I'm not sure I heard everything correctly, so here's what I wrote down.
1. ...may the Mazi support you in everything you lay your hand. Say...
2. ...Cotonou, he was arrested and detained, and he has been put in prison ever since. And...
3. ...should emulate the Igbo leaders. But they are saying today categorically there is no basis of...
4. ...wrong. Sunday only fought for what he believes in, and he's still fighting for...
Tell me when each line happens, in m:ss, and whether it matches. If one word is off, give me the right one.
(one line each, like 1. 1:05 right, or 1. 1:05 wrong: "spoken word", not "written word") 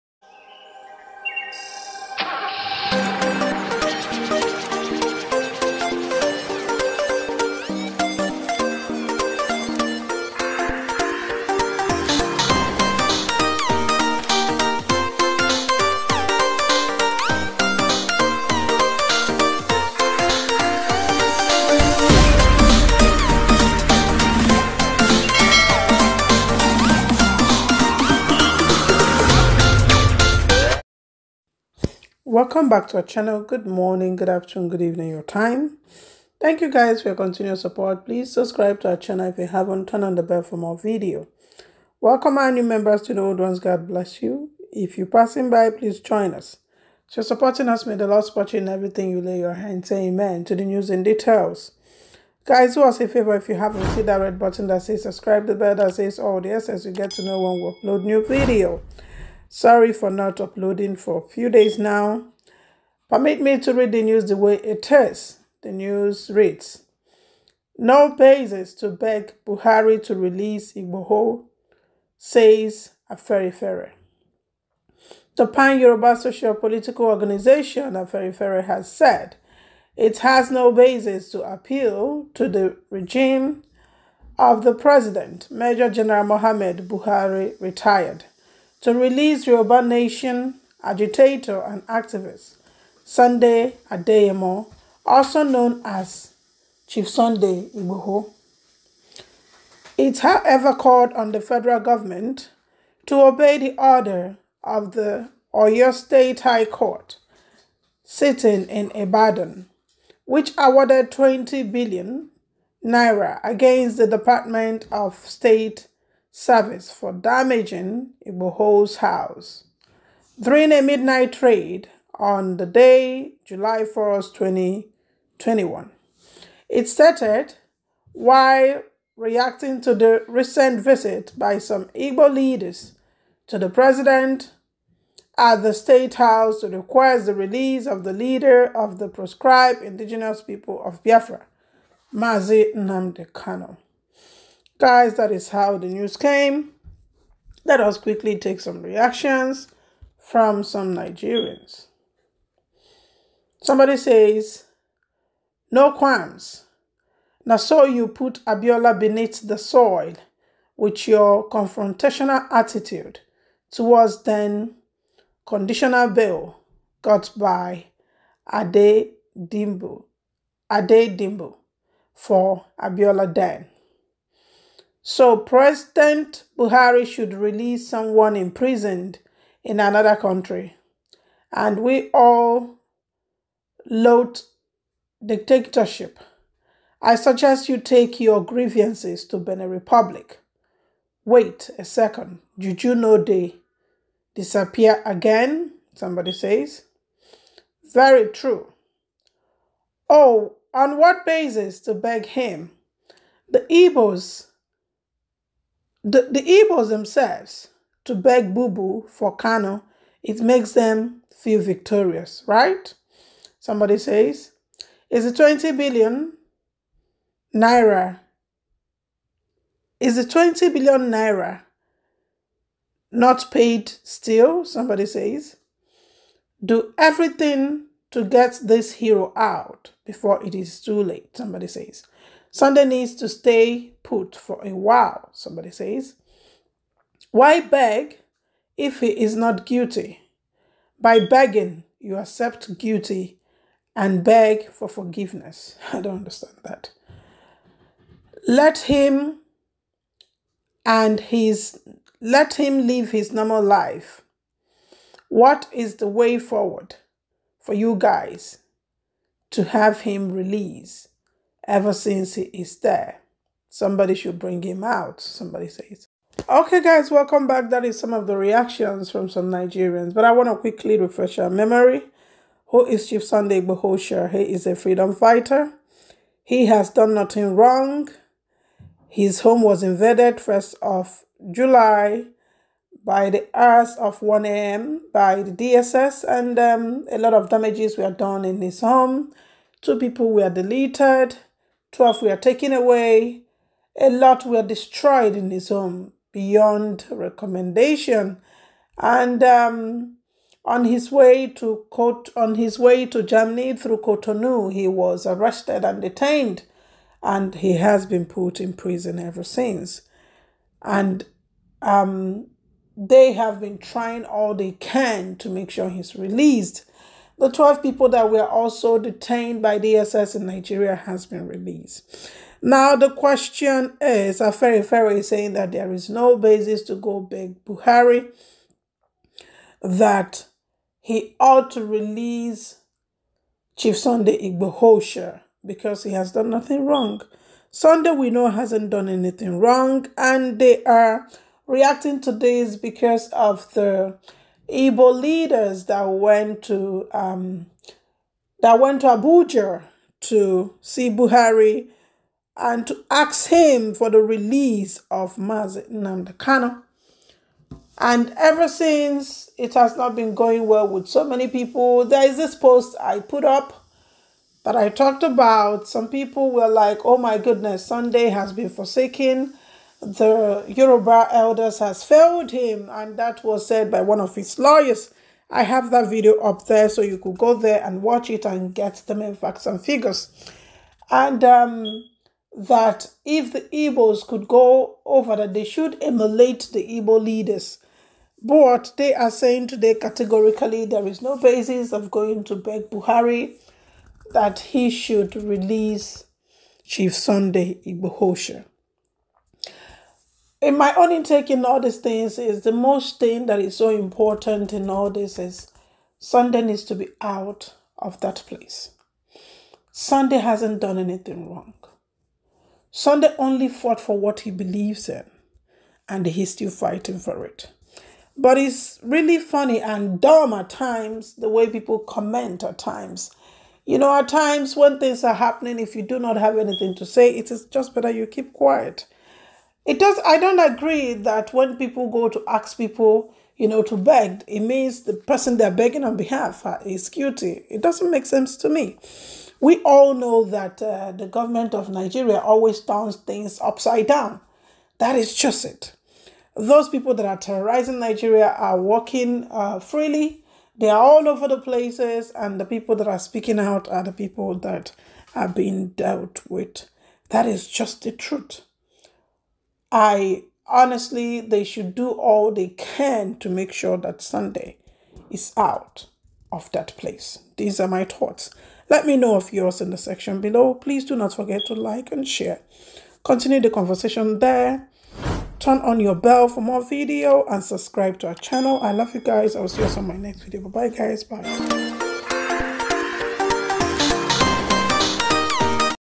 1. 0:47 wrong: "Lord", not "Mazi"
2. 5:03 right
3. 6:25 right
4. 6:51 right.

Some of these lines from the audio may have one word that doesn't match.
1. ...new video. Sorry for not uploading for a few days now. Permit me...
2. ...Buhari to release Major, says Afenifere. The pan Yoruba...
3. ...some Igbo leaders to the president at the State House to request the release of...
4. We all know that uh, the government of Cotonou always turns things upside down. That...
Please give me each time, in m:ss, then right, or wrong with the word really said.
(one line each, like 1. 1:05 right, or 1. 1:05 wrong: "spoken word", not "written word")
1. 0:58 right
2. 1:09 wrong: "Igboho", not "Major"
3. 2:11 right
4. 7:19 wrong: "Nigeria", not "Cotonou".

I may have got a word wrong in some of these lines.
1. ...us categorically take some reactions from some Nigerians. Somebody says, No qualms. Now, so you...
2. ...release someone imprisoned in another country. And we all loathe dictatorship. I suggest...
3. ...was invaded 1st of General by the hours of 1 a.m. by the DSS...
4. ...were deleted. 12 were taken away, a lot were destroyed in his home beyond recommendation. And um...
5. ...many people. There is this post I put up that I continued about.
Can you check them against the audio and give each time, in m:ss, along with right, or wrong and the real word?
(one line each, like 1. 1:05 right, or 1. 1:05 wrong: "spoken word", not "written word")
1. 2:27 wrong: "quickly", not "categorically"
2. 2:57 right
3. 4:39 wrong: "July", not "General"
4. 4:50 right
5. 6:01 wrong: "talked", not "continued".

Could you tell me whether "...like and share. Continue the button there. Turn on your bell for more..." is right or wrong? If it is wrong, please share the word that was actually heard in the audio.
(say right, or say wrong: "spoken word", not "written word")
wrong: "conversation", not "button".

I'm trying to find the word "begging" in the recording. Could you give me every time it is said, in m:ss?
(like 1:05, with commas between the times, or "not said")
4:01, 7:15.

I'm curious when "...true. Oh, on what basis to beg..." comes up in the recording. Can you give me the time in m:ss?
3:18.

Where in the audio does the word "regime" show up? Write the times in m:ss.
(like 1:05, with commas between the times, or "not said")
1:22.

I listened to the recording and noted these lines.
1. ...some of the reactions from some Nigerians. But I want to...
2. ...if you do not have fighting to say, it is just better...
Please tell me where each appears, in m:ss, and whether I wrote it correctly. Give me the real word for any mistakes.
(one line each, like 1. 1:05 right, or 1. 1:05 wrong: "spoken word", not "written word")
1. 4:27 right
2. 7:05 wrong: "anything", not "fighting".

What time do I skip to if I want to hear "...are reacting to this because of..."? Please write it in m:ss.
5:40.